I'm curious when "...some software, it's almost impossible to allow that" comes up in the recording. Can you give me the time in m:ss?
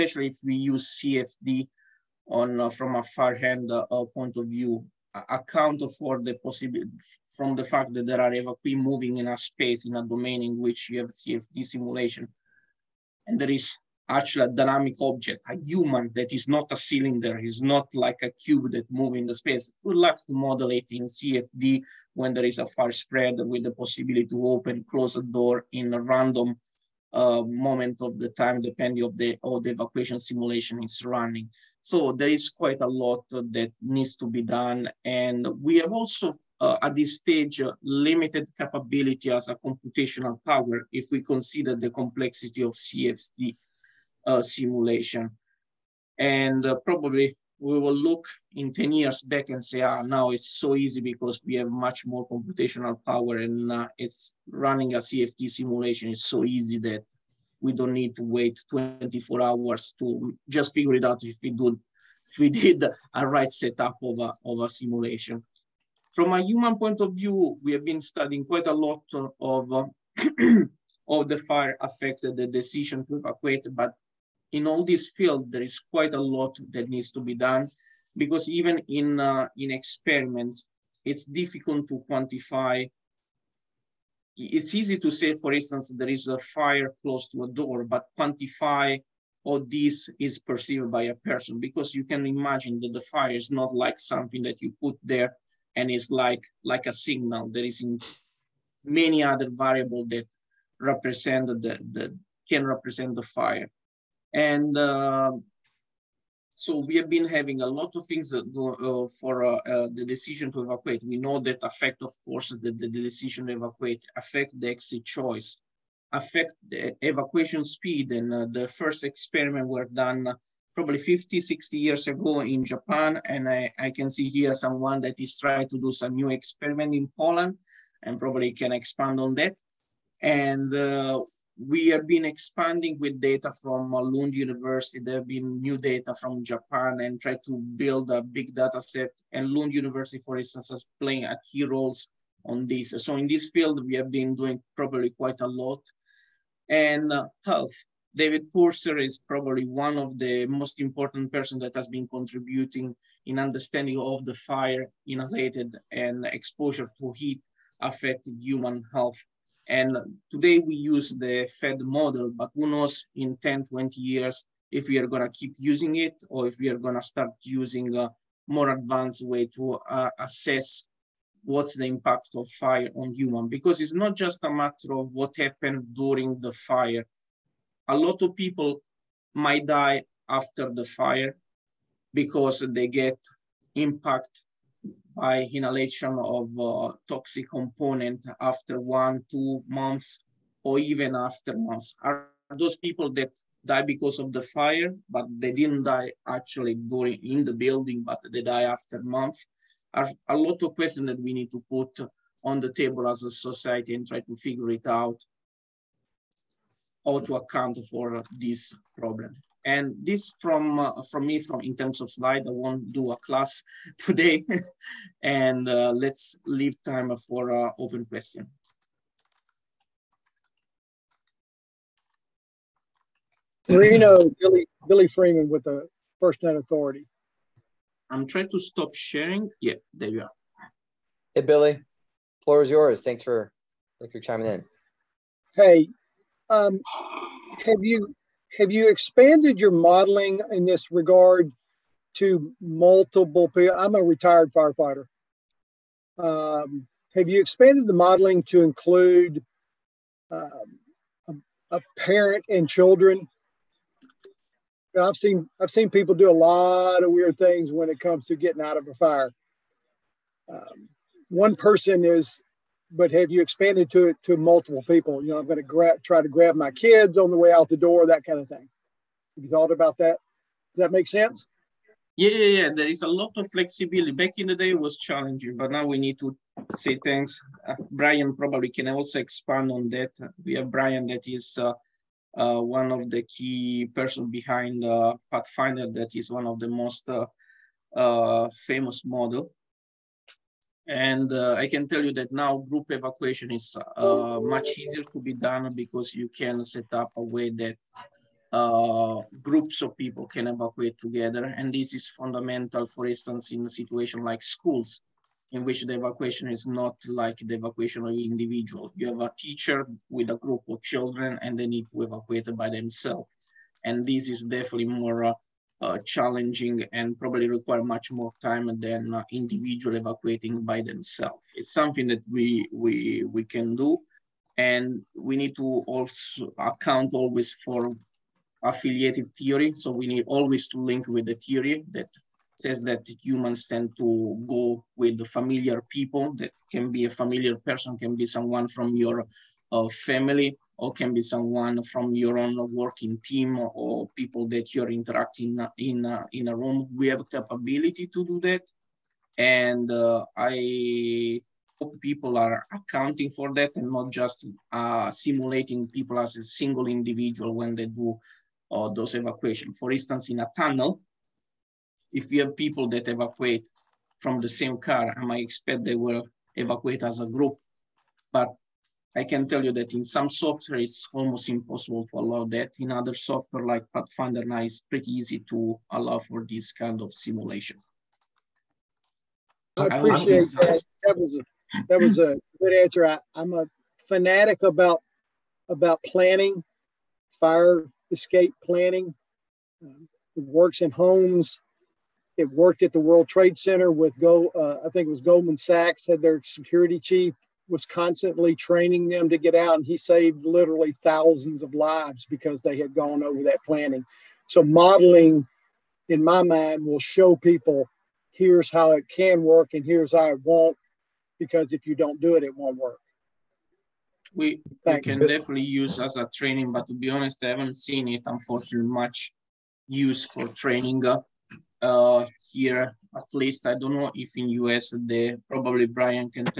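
6:10.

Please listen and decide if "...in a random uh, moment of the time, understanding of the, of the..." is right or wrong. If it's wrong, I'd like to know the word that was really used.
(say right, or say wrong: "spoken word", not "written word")
wrong: "depending", not "understanding".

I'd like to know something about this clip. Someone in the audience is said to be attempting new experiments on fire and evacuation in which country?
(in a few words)
Poland.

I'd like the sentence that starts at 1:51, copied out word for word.
We know that affect, of course, the, the, decision to evacuate, affect the exit choice, affect the evacuation speed.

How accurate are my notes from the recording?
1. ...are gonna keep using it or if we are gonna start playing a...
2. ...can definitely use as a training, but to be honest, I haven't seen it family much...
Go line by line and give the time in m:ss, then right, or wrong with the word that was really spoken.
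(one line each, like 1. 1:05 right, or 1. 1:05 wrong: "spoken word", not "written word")
1. 2:44 wrong: "using", not "playing"
2. 6:54 wrong: "unfortunately", not "family".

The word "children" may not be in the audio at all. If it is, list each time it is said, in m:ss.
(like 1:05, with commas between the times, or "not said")
4:12, 5:10.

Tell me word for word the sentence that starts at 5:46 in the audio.
We have capability to do that.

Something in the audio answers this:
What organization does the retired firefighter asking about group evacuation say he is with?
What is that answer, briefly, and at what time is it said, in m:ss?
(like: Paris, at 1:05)
FirstNet Authority, at 3:46.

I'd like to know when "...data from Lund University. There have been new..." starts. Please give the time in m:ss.
2:13.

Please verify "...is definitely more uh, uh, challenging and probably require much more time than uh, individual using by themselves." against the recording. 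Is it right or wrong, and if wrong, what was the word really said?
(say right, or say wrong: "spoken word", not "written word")
wrong: "evacuating", not "using".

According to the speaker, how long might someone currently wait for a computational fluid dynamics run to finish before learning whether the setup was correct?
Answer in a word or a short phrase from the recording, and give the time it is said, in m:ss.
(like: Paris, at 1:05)
24 hours, at 0:58.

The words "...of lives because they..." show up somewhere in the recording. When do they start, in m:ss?
6:41.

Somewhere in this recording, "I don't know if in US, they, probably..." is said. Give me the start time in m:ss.
7:03.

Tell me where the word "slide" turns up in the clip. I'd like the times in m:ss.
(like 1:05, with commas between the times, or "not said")
3:32.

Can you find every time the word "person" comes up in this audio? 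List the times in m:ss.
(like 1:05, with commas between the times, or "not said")
1:31, 2:31, 4:21, 4:43, 5:37.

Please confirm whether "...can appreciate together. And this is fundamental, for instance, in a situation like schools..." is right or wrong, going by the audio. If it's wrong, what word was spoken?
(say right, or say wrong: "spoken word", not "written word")
wrong: "evacuate", not "appreciate".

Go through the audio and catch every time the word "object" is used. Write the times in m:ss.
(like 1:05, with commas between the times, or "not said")
0:15.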